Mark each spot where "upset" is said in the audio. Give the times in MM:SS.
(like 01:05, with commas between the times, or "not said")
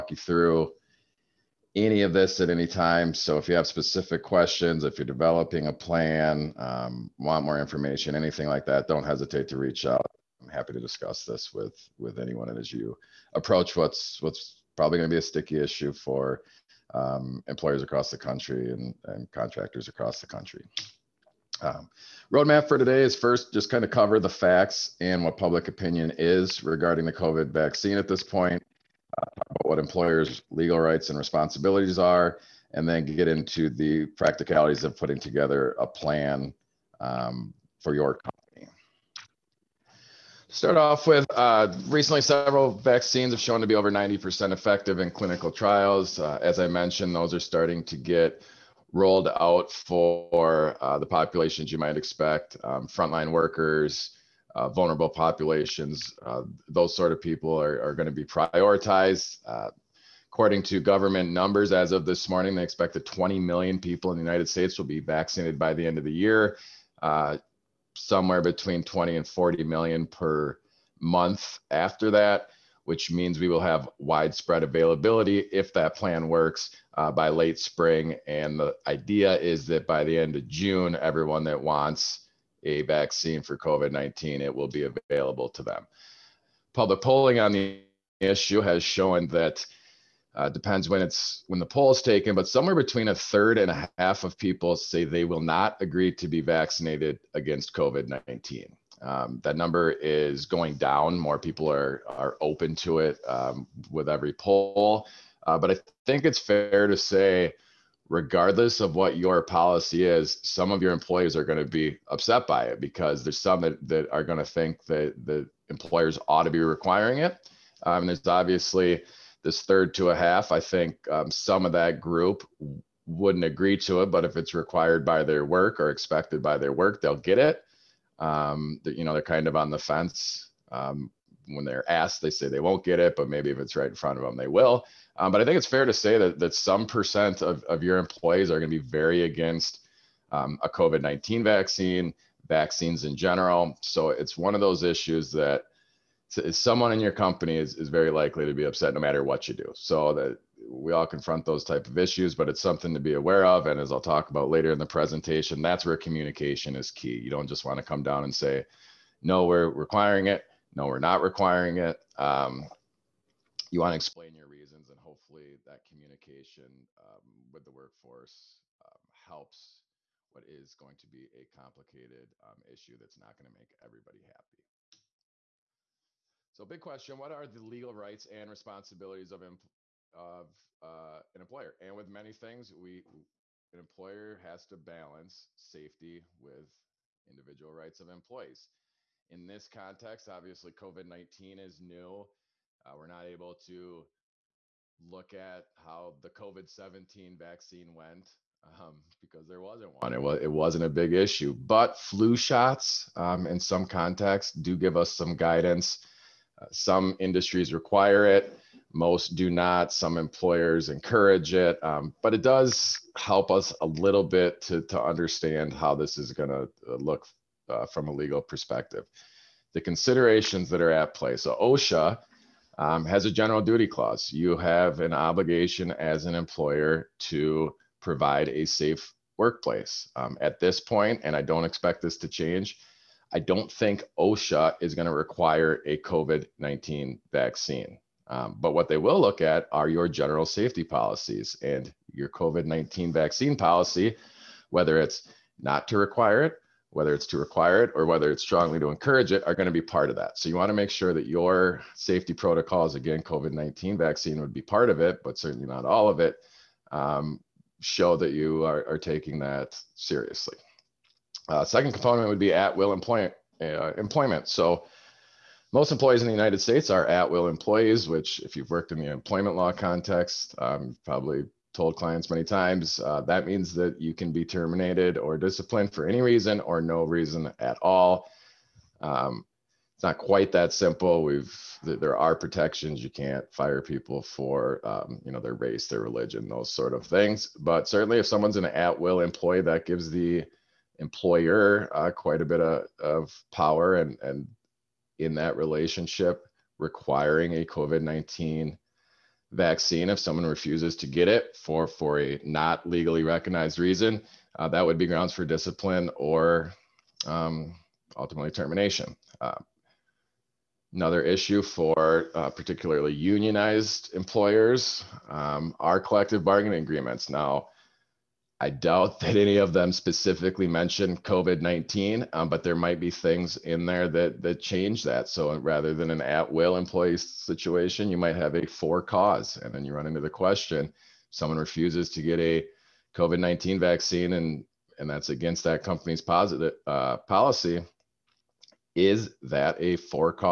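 01:52, 02:28.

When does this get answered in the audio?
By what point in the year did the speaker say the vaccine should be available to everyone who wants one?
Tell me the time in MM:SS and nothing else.
01:20.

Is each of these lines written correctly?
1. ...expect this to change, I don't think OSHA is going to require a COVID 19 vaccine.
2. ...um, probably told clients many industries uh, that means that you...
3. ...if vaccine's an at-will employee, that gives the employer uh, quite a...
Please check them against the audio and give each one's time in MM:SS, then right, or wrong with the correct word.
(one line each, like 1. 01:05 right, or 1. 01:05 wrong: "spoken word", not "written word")
1. 03:51 right
2. 04:30 wrong: "times", not "industries"
3. 04:48 wrong: "someone", not "vaccine".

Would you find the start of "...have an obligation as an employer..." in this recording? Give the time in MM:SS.
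03:44.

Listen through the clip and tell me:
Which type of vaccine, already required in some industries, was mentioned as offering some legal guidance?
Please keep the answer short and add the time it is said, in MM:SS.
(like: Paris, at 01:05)
flu shots, at 03:21.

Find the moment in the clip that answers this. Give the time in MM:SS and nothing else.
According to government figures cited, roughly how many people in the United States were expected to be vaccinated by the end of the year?
01:03.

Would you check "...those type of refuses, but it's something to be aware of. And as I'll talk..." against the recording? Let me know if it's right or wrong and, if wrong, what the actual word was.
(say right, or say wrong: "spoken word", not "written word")
wrong: "issues", not "refuses".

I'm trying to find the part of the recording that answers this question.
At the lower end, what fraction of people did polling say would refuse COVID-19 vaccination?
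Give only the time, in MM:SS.
01:33.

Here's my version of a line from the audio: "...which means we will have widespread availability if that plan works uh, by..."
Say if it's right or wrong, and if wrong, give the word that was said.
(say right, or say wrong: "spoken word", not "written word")
right.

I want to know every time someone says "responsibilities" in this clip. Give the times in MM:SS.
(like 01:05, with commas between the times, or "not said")
00:31, 02:58.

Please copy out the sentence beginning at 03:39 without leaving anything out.
The considerations that are at play.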